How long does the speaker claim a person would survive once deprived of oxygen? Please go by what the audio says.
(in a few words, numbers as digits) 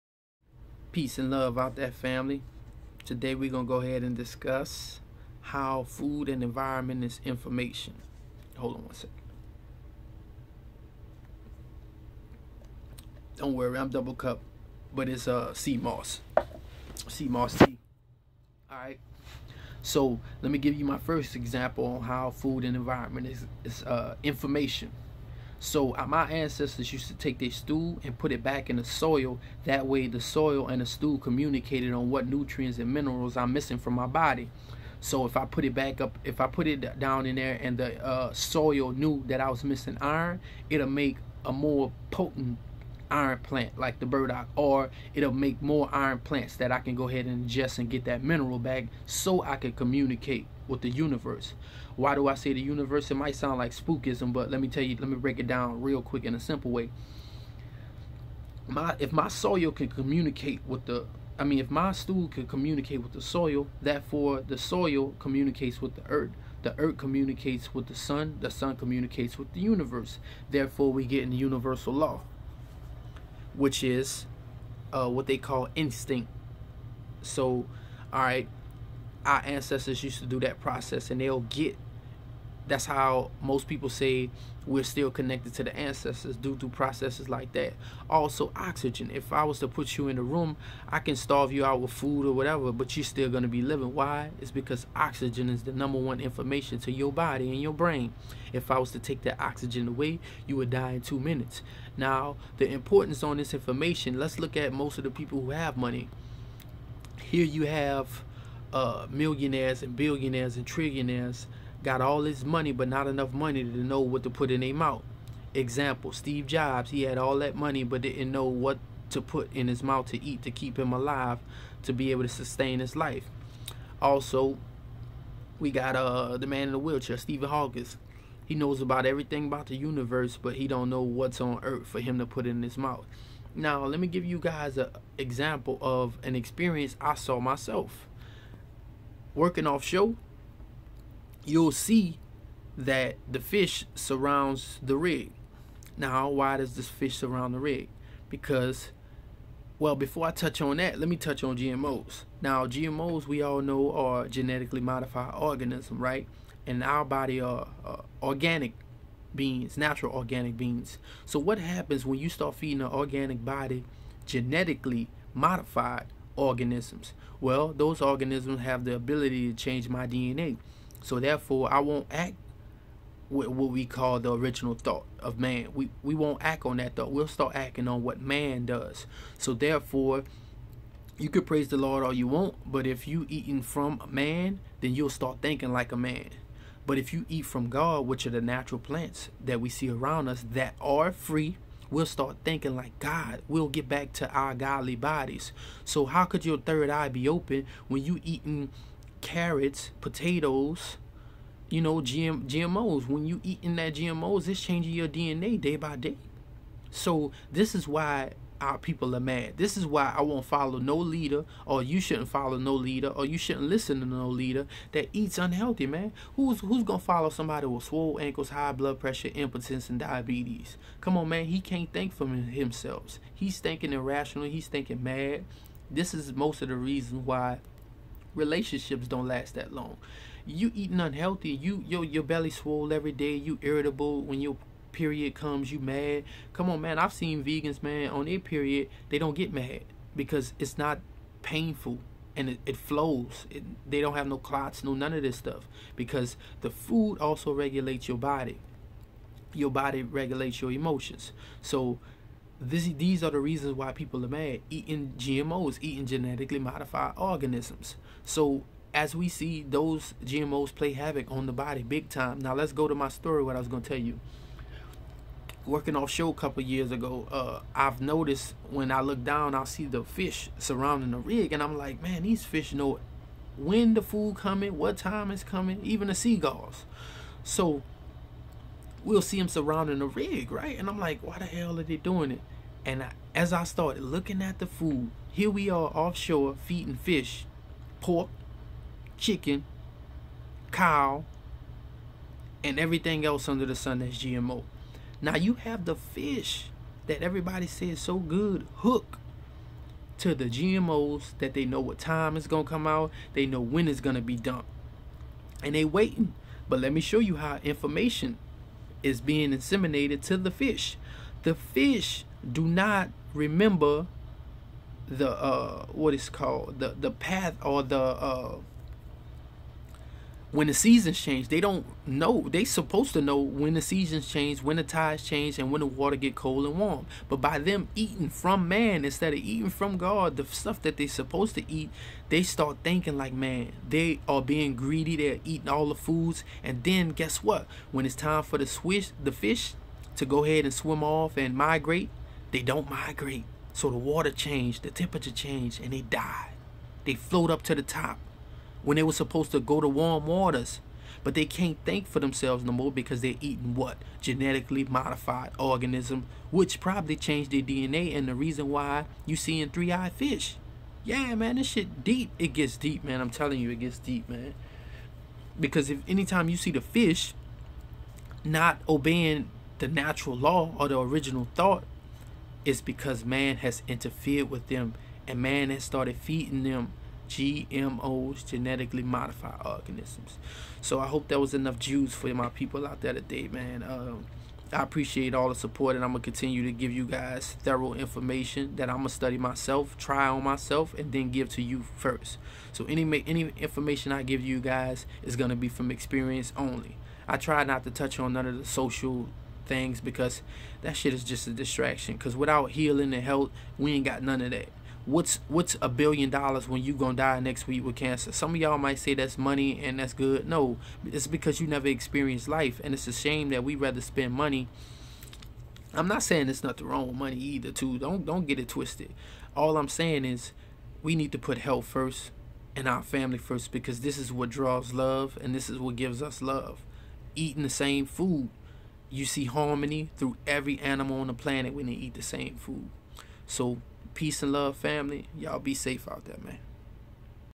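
2 minutes.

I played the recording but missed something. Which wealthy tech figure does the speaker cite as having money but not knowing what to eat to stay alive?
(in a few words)
Steve Jobs.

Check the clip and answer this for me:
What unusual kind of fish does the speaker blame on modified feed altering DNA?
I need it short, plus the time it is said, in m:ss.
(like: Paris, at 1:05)
Three-eyed fish, at 5:59.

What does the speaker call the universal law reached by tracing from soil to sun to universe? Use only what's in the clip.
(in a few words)
Instinct.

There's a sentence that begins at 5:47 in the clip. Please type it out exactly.
They float up to the top when they were supposed to go to warm waters.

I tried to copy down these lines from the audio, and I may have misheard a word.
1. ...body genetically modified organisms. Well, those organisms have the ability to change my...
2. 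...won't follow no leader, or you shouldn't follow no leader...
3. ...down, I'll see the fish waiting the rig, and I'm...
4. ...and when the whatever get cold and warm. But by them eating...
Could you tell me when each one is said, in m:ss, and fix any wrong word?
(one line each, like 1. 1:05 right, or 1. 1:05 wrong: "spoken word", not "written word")
1. 2:43 right
2. 3:30 right
3. 4:29 wrong: "surrounding", not "waiting"
4. 5:25 wrong: "water", not "whatever".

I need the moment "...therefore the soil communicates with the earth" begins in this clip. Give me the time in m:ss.
1:03.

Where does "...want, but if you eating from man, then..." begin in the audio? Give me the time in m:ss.
3:02.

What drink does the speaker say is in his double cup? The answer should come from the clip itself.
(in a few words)
Sea moss tea.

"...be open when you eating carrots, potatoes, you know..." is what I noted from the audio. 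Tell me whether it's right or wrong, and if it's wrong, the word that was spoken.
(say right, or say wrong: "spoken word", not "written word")
right.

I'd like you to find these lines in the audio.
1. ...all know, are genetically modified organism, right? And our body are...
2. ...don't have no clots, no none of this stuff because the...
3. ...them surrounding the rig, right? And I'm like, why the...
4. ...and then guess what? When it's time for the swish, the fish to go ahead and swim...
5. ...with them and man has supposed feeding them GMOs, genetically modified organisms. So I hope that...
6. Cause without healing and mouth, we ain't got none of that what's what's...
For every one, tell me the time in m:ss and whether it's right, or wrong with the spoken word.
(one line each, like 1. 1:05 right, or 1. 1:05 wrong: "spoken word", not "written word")
1. 2:33 right
2. 4:04 right
3. 4:39 right
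4. 5:36 right
5. 6:14 wrong: "started", not "supposed"
6. 6:42 wrong: "health", not "mouth".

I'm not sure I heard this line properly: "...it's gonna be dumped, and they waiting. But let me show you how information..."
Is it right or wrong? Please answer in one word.
right.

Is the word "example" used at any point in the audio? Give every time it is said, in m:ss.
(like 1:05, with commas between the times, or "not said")
0:21, 1:55, 2:15.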